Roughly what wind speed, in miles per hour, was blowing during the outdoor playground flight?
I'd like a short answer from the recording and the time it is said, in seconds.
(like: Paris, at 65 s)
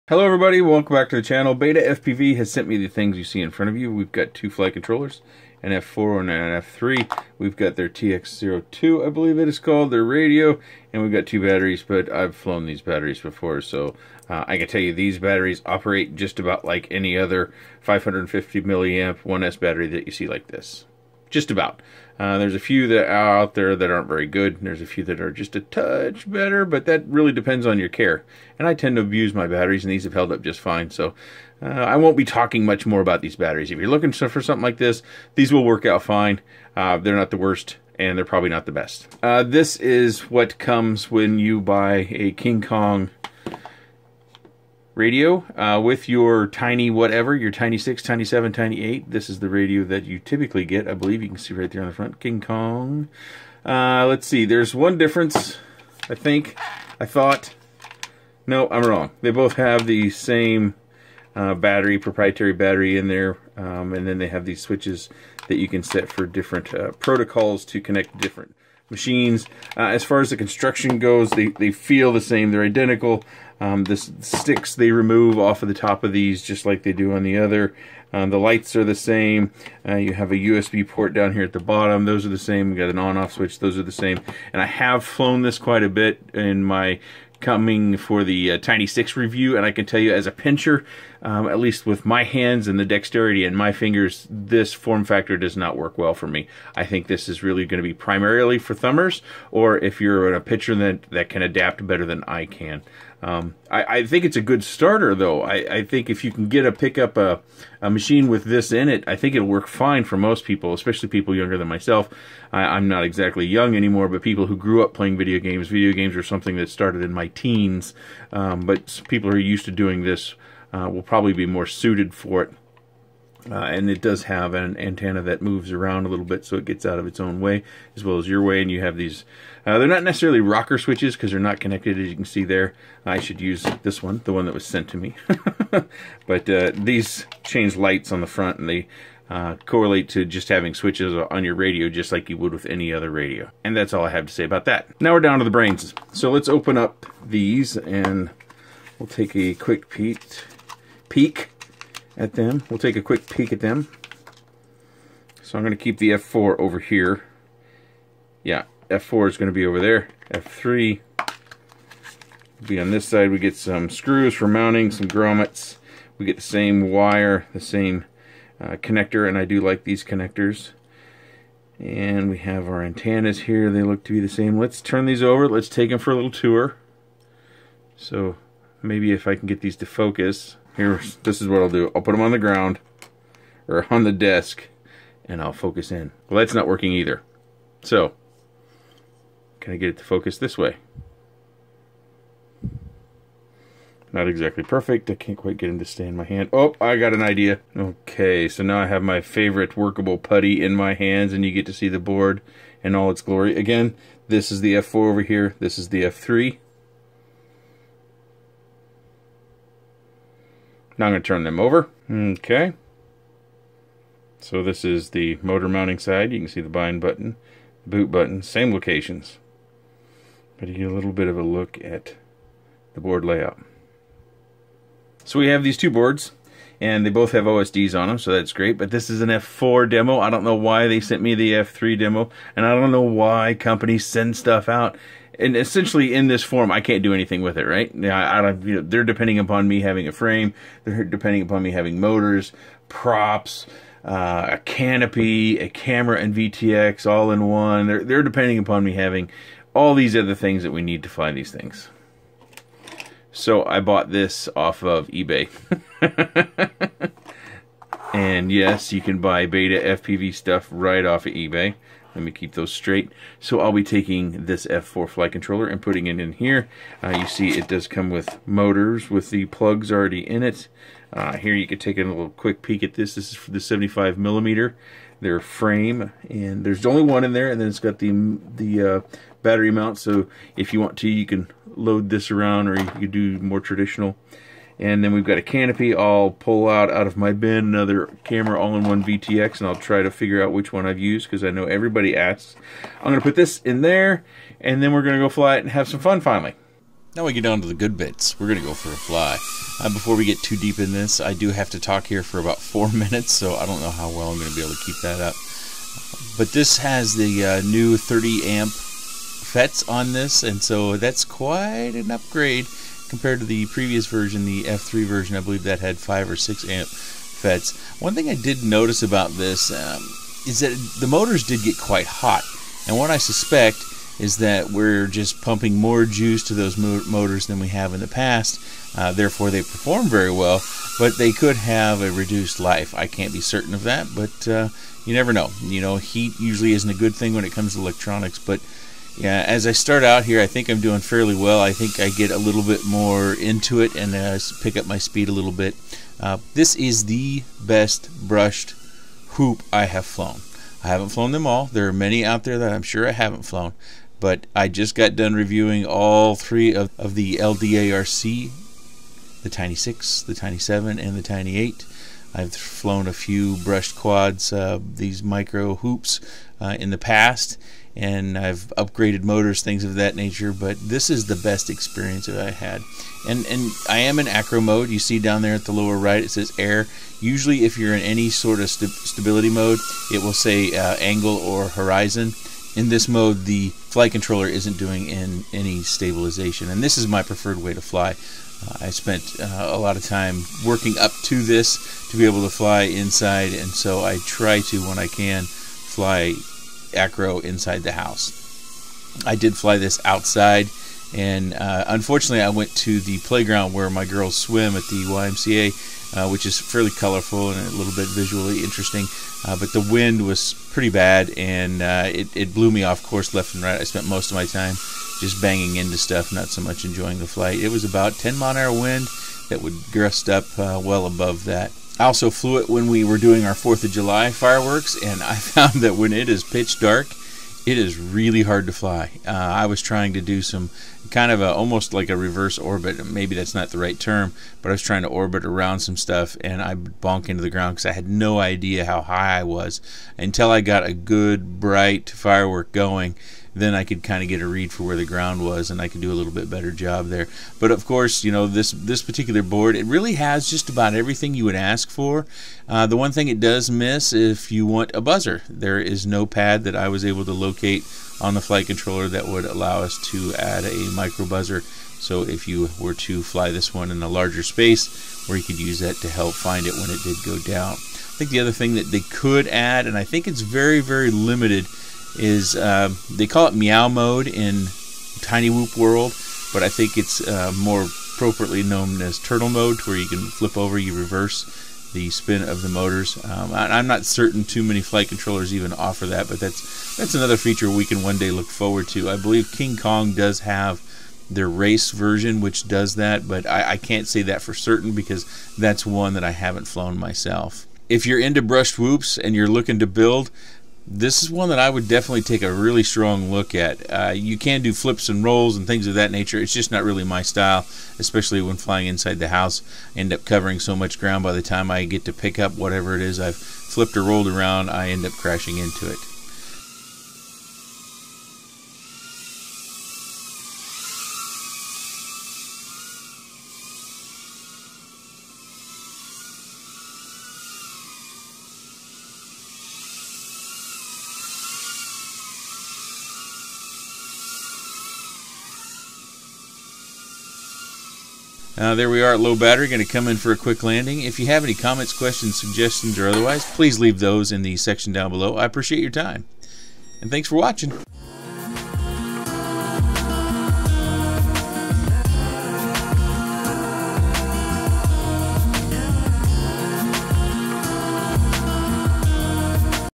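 10, at 418 s.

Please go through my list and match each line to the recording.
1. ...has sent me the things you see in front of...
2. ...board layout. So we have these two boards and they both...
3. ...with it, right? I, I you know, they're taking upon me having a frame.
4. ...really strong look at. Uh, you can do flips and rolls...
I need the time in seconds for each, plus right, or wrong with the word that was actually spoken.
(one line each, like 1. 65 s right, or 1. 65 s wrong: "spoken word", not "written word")
1. 2 s right
2. 223 s right
3. 237 s wrong: "depending", not "taking"
4. 502 s right.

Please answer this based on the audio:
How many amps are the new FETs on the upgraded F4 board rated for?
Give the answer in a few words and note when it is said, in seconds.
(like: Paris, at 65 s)
30, at 307 s.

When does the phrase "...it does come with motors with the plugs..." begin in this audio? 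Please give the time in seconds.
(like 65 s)
267 s.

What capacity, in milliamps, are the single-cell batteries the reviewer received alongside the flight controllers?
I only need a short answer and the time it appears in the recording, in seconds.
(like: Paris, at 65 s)
550, at 17 s.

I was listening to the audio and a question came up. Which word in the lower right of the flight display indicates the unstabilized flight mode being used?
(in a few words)
air.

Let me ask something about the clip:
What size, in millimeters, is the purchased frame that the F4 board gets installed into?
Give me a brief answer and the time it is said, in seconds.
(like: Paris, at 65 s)
75, at 273 s.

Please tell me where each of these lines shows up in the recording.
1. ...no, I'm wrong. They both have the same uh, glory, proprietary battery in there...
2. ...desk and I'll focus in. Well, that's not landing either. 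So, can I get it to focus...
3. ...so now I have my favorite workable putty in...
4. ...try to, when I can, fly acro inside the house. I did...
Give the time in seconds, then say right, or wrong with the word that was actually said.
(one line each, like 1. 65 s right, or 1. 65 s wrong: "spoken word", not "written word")
1. 58 s wrong: "battery", not "glory"
2. 184 s wrong: "working", not "landing"
3. 198 s right
4. 394 s right.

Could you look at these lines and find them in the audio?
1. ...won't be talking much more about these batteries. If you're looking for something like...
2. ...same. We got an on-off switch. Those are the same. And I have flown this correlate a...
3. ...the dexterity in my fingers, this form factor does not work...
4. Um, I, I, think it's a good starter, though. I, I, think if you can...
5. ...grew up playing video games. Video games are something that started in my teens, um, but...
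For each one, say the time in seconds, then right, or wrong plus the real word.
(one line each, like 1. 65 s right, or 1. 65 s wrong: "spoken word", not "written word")
1. 31 s right
2. 82 s wrong: "quite", not "correlate"
3. 92 s right
4. 103 s right
5. 114 s right.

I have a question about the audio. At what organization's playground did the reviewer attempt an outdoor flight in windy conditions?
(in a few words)
YMCA.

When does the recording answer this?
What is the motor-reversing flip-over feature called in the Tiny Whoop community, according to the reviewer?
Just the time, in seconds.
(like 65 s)
473 s.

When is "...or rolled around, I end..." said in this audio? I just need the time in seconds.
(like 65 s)
513 s.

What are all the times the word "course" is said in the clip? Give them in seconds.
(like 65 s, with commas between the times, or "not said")
413 s, 447 s.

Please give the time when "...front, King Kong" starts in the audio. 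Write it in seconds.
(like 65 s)
51 s.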